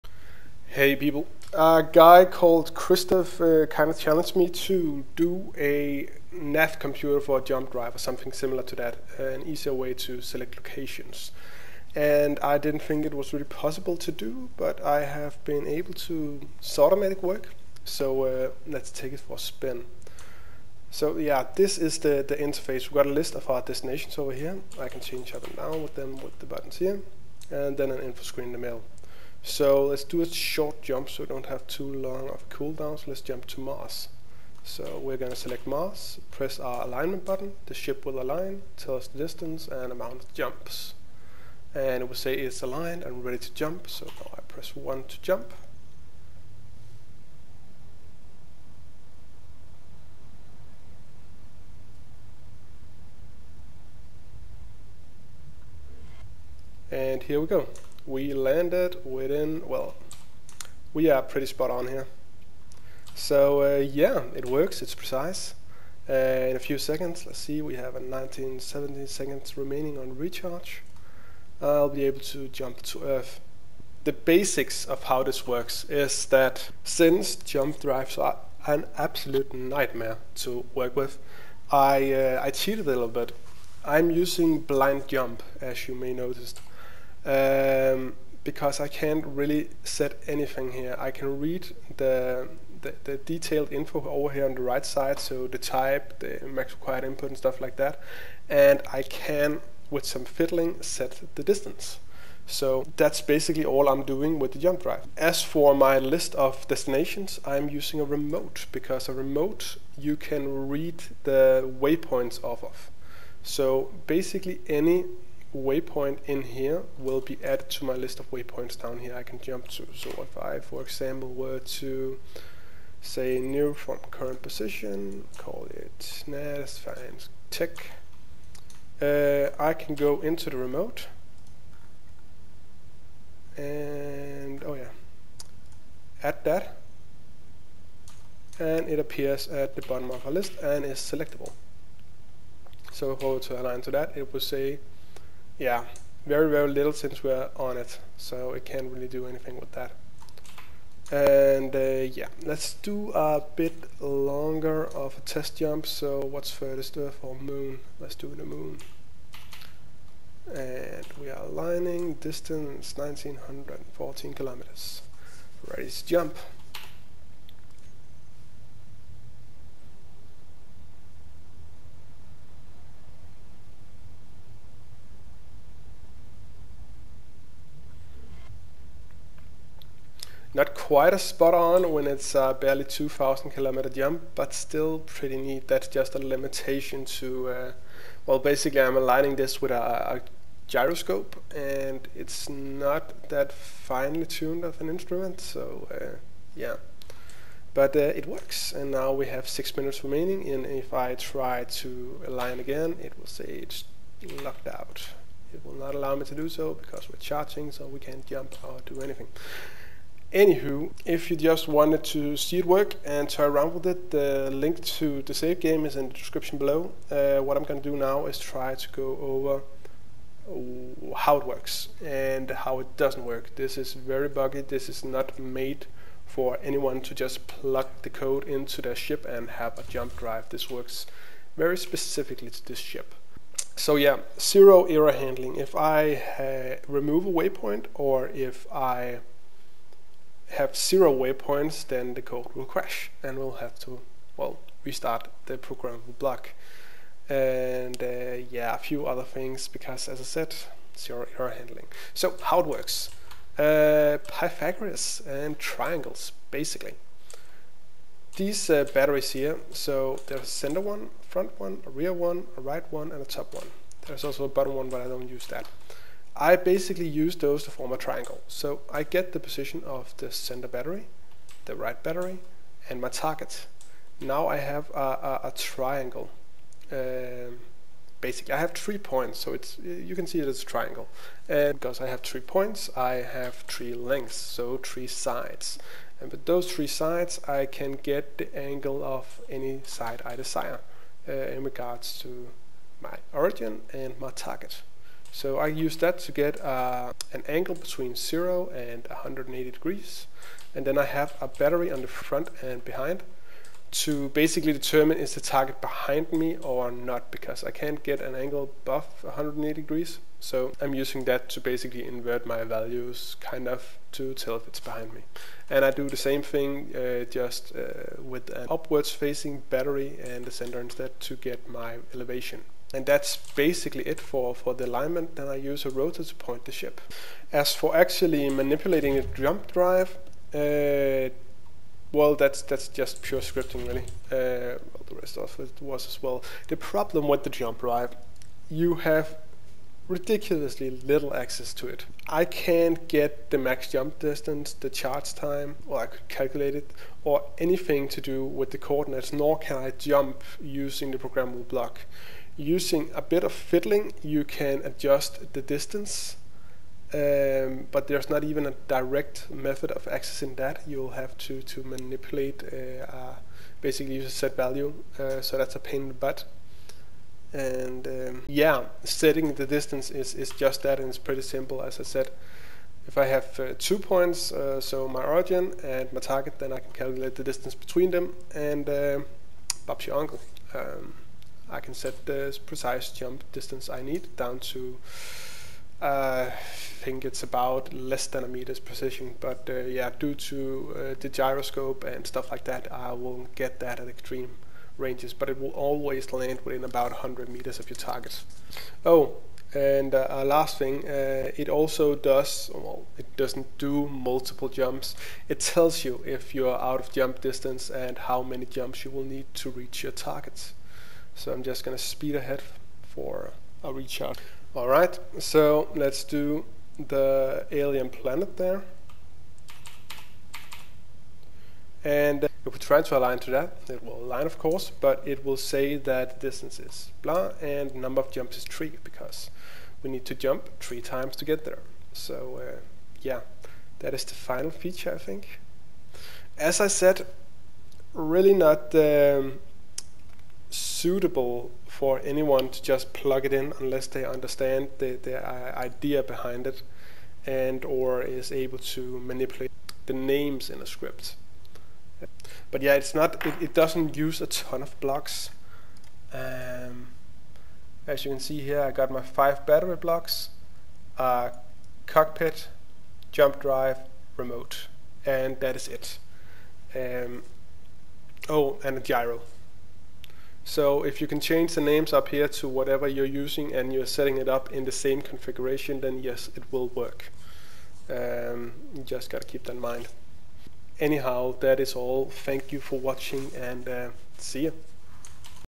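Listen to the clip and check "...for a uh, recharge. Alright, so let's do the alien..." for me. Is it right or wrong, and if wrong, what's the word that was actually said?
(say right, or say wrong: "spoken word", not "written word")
right.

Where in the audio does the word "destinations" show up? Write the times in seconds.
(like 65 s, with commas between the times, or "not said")
23 s, 106 s.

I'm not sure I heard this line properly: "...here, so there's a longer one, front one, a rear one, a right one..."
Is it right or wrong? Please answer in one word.
wrong.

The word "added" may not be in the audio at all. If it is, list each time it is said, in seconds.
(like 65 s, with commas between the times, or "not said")
117 s.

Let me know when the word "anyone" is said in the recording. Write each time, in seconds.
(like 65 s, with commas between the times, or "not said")
226 s, 442 s.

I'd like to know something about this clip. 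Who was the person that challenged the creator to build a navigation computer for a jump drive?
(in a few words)
Christoph.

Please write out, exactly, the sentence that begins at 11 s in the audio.
And I didn't think it was really possible to do, but I have been able to sort of make it work.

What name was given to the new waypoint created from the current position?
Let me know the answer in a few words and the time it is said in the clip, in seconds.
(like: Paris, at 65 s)
NAS, at 126 s.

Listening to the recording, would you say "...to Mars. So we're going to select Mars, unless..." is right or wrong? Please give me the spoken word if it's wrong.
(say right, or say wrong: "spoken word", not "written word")
wrong: "press", not "unless".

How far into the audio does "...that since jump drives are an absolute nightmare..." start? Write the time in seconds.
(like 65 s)
76 s.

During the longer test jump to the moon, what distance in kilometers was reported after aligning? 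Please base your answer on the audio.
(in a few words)
1914.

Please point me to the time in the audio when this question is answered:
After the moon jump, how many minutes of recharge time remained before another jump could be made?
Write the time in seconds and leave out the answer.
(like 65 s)
199 s.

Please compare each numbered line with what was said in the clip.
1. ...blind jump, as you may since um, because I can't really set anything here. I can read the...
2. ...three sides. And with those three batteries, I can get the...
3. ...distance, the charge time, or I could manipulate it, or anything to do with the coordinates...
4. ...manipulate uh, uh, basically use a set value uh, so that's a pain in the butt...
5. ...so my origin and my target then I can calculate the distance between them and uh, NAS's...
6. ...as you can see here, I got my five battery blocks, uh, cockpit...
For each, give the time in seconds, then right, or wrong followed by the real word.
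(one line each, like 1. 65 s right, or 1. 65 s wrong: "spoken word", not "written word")
1. 84 s wrong: "notice", not "since"
2. 284 s wrong: "sides", not "batteries"
3. 344 s wrong: "calculate", not "manipulate"
4. 361 s right
5. 374 s wrong: "Bob", not "NAS"
6. 458 s right.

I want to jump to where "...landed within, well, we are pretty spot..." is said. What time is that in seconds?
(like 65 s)
58 s.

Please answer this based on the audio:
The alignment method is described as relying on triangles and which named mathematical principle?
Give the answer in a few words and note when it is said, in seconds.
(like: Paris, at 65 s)
Pythagoras, at 254 s.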